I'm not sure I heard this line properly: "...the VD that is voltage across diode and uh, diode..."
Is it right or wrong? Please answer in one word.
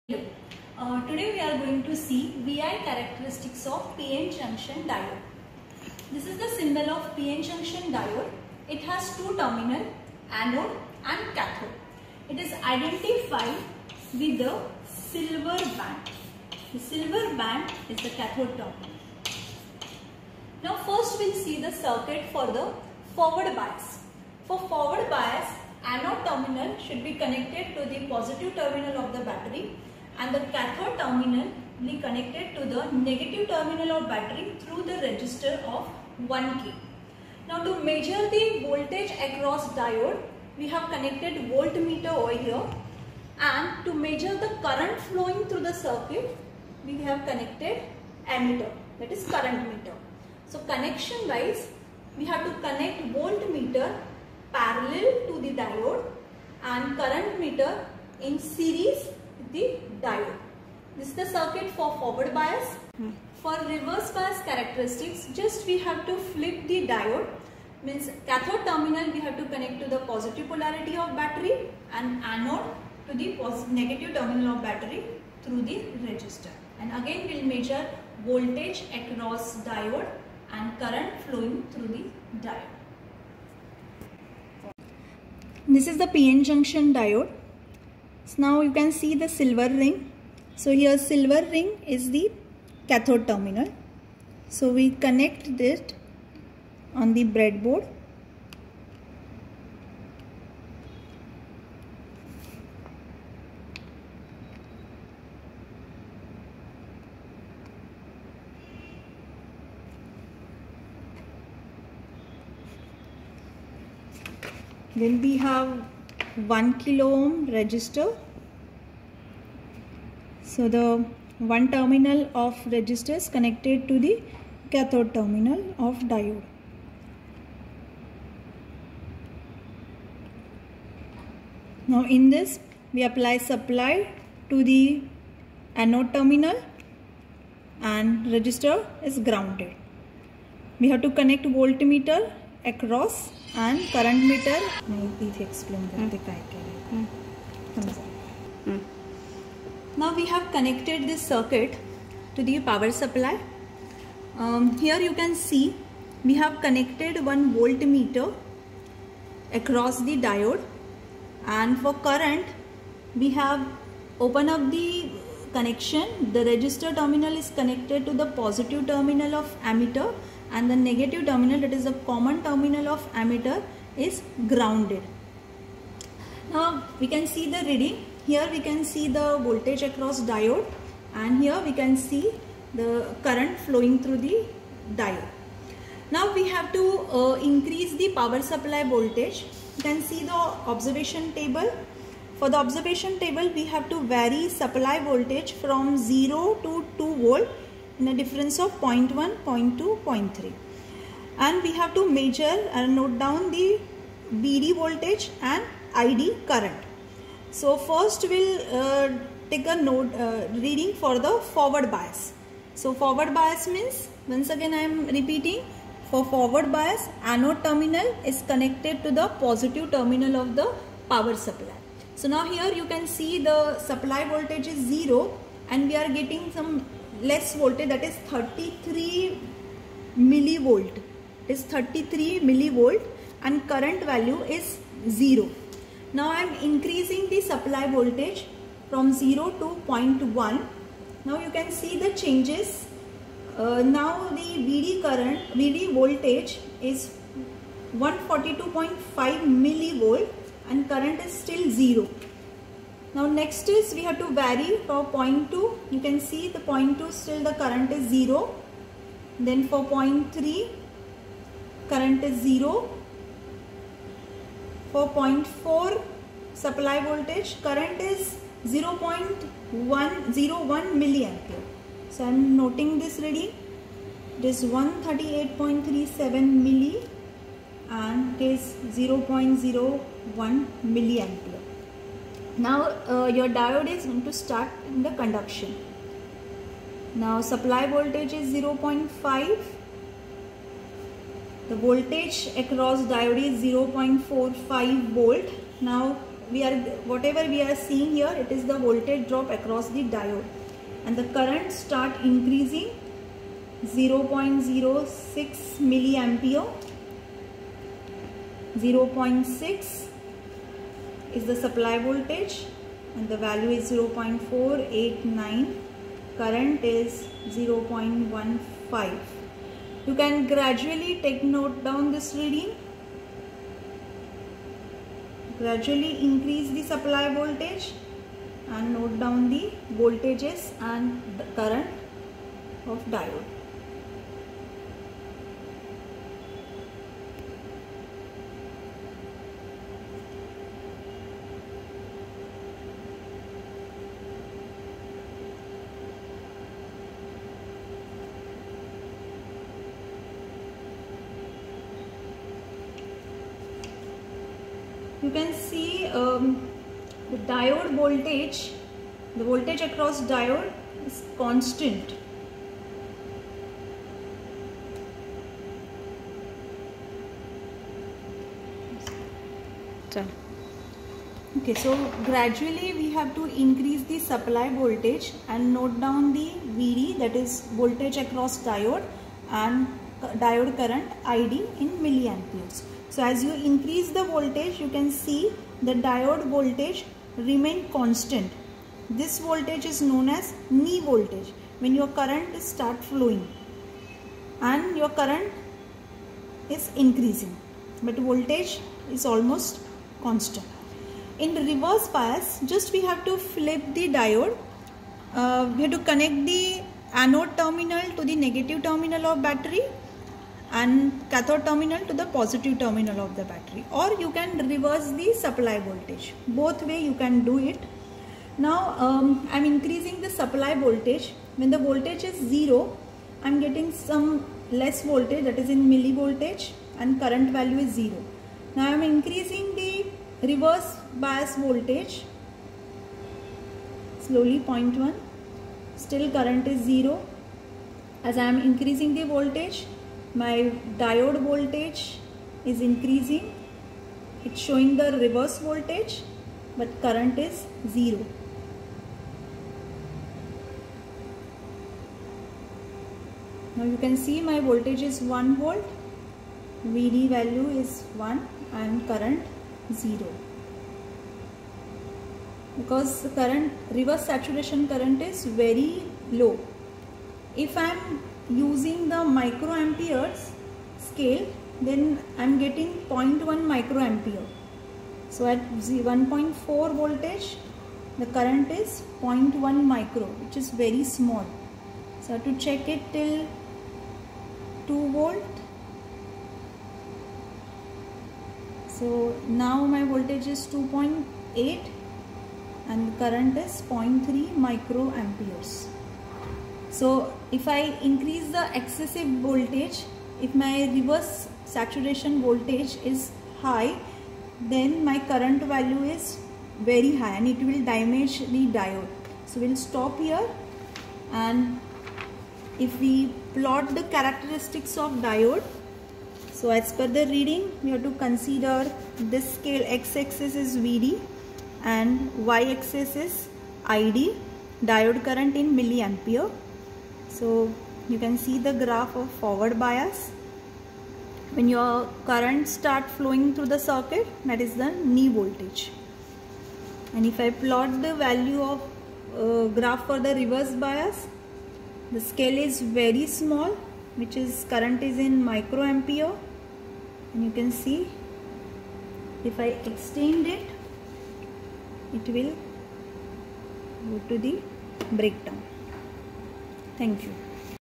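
right.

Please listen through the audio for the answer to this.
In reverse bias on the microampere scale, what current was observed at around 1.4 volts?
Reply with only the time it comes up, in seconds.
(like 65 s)
473 s.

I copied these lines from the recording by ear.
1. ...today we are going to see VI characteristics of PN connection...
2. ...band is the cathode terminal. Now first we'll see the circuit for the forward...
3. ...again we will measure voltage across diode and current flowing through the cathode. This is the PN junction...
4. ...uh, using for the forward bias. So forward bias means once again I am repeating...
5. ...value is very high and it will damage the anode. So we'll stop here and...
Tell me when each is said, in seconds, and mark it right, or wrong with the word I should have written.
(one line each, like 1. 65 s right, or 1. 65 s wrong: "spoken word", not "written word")
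1. 1 s wrong: "junction", not "connection"
2. 17 s right
3. 77 s wrong: "diode", not "cathode"
4. 210 s wrong: "reading", not "using"
5. 505 s wrong: "diode", not "anode".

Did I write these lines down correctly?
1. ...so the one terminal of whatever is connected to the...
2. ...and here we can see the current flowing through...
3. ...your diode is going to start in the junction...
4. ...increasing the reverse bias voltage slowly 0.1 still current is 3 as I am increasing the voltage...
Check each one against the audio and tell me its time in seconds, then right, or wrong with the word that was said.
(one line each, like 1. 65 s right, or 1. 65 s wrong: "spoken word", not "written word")
1. 120 s wrong: "register", not "whatever"
2. 181 s right
3. 283 s wrong: "conduction", not "junction"
4. 429 s wrong: "0", not "3".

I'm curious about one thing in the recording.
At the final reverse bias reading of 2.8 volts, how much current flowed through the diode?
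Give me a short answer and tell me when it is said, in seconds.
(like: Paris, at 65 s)
0.3 microamperes, at 493 s.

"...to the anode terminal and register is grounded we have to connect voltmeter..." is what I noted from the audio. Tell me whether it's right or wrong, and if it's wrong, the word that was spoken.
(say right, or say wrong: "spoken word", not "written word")
right.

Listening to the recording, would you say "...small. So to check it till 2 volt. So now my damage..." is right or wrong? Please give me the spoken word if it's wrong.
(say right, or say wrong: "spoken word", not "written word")
wrong: "voltage", not "damage".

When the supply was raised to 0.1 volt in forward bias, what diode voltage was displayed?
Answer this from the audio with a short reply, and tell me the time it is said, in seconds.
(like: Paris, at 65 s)
142.5 millivolt, at 247 s.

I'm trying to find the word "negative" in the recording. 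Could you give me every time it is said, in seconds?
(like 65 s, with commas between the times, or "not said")
32 s, 73 s, 170 s, 408 s.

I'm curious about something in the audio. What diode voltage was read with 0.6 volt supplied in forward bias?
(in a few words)
0.489.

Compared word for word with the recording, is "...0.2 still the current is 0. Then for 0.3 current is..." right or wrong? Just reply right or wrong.
right.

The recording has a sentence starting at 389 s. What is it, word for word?
This voltage is known as knee voltage when your current start flowing and your current is increasing but voltage is almost constant.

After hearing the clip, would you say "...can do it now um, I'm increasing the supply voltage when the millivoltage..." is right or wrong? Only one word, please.
wrong.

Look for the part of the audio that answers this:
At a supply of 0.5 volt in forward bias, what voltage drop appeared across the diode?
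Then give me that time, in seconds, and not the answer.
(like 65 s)
293 s.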